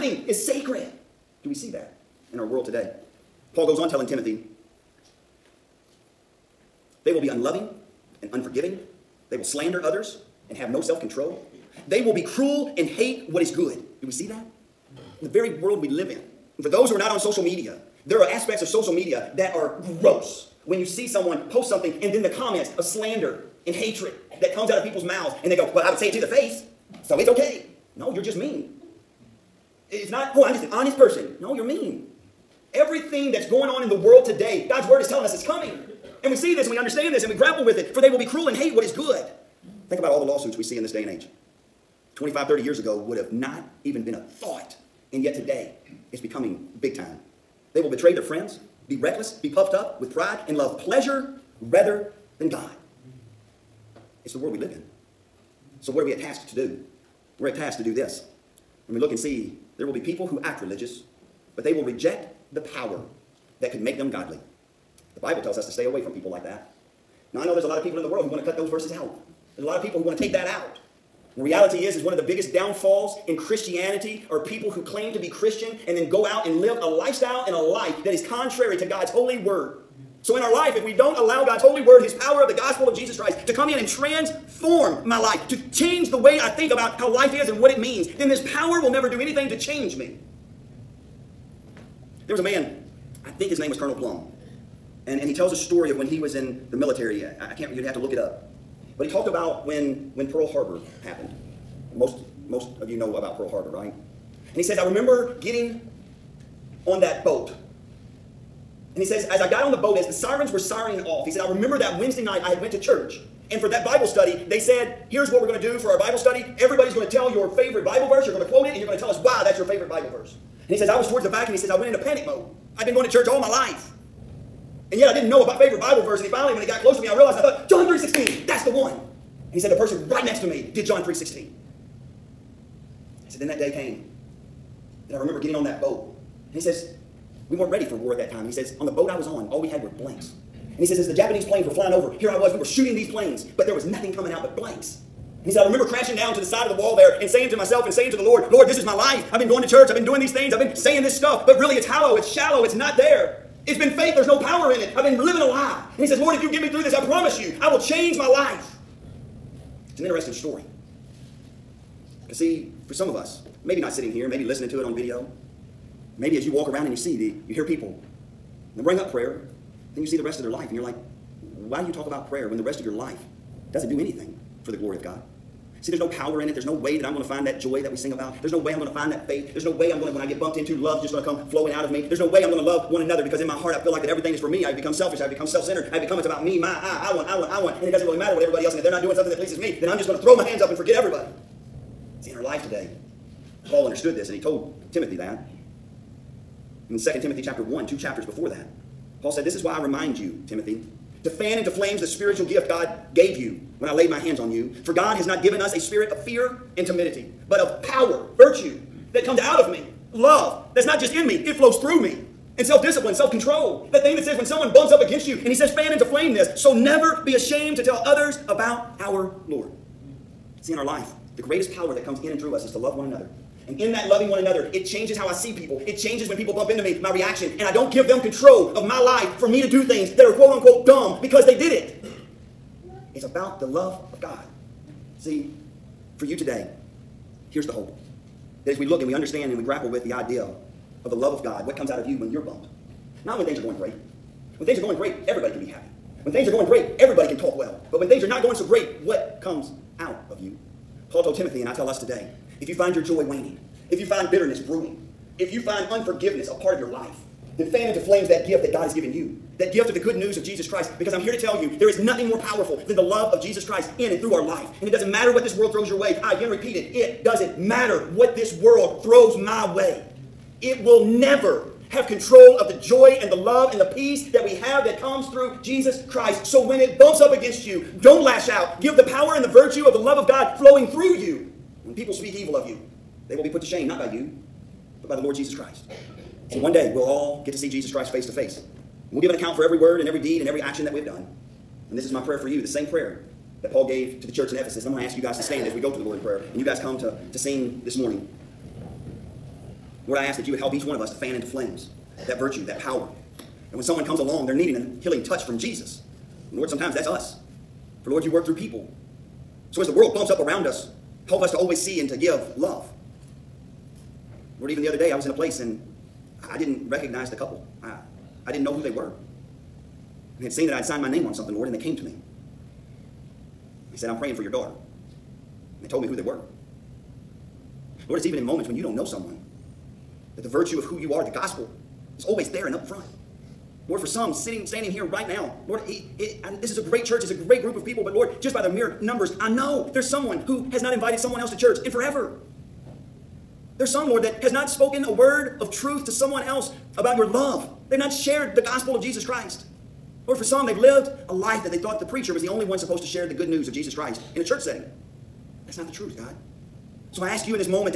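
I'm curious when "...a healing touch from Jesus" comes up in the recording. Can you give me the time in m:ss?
5:04.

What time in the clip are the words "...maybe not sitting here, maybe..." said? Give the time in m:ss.
2:43.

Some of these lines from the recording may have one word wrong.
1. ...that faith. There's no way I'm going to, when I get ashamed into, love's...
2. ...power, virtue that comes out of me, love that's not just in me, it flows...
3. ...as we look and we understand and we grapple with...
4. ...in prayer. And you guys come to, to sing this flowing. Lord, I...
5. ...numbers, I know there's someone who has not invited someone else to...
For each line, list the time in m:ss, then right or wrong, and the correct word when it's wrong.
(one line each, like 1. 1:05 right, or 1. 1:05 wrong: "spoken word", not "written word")
1. 2:59 wrong: "bumped", not "ashamed"
2. 3:27 right
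3. 3:58 right
4. 4:56 wrong: "morning", not "flowing"
5. 5:39 right.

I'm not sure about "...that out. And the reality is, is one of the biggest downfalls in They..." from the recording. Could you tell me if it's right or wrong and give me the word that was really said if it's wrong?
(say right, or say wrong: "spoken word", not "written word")
wrong: "Christianity", not "They".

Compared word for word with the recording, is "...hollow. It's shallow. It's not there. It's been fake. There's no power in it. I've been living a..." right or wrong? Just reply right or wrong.
right.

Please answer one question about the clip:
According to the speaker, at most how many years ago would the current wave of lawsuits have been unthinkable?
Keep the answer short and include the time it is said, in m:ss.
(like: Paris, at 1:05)
30, at 0:42.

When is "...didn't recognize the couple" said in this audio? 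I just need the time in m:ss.
5:16.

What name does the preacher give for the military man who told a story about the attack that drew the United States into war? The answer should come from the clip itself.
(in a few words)
Colonel Plum.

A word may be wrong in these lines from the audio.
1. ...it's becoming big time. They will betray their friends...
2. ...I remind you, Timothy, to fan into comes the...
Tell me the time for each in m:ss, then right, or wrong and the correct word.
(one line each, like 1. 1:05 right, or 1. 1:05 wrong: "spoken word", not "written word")
1. 0:46 right
2. 3:19 wrong: "flames", not "comes".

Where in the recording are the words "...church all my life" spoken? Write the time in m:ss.
2:03.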